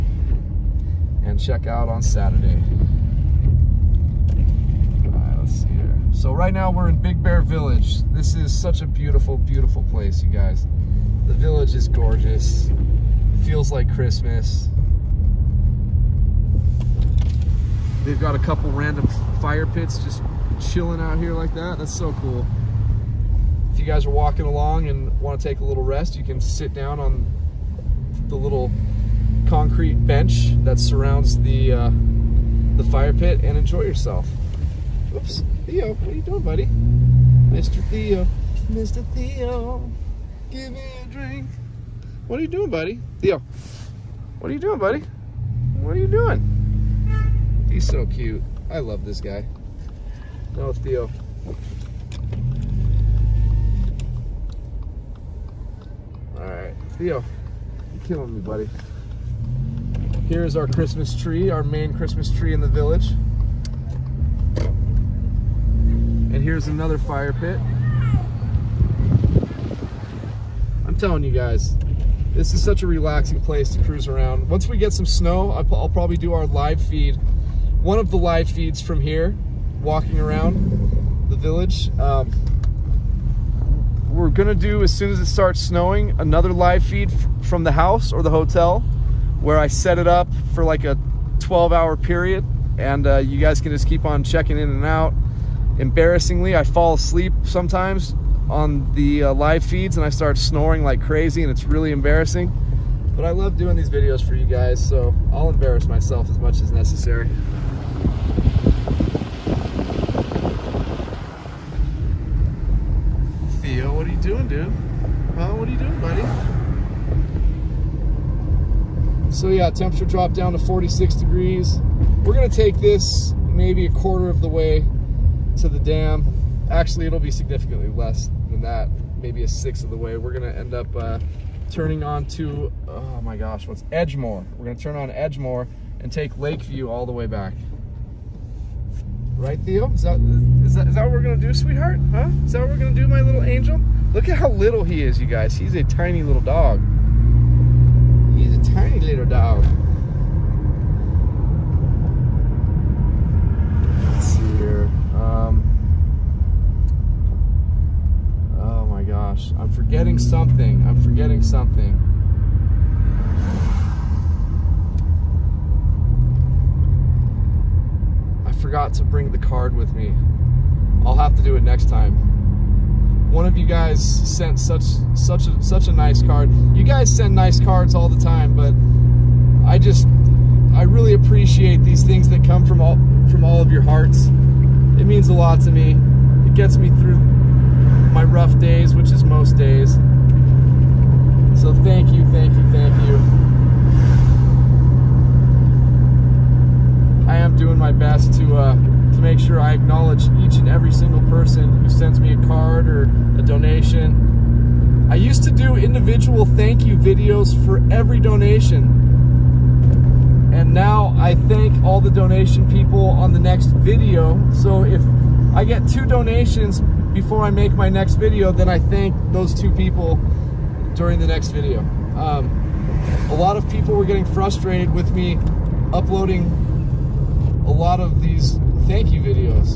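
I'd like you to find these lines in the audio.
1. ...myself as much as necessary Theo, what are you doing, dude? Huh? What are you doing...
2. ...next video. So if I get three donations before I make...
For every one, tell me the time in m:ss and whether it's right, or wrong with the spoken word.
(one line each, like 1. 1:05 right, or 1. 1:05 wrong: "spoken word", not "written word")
1. 1:45 right
2. 3:33 wrong: "two", not "three".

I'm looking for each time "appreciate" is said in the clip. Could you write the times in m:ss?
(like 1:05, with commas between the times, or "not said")
3:01.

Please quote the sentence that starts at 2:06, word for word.
Actually, it'll be significantly less than that, maybe a sixth of the way.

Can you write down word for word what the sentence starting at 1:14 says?
Once we get some snow, I'll probably do our live feed one of the live feeds from here, walking around the village.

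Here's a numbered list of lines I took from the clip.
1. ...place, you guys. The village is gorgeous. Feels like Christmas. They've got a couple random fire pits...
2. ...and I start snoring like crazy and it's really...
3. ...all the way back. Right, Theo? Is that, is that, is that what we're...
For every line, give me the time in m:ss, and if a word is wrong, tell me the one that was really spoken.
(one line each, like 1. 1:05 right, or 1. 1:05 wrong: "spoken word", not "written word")
1. 0:09 right
2. 1:39 right
3. 2:16 right.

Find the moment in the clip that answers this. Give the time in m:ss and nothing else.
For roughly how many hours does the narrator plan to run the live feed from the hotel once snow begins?
1:31.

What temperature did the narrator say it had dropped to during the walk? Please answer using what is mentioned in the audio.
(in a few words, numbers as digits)
46 degrees.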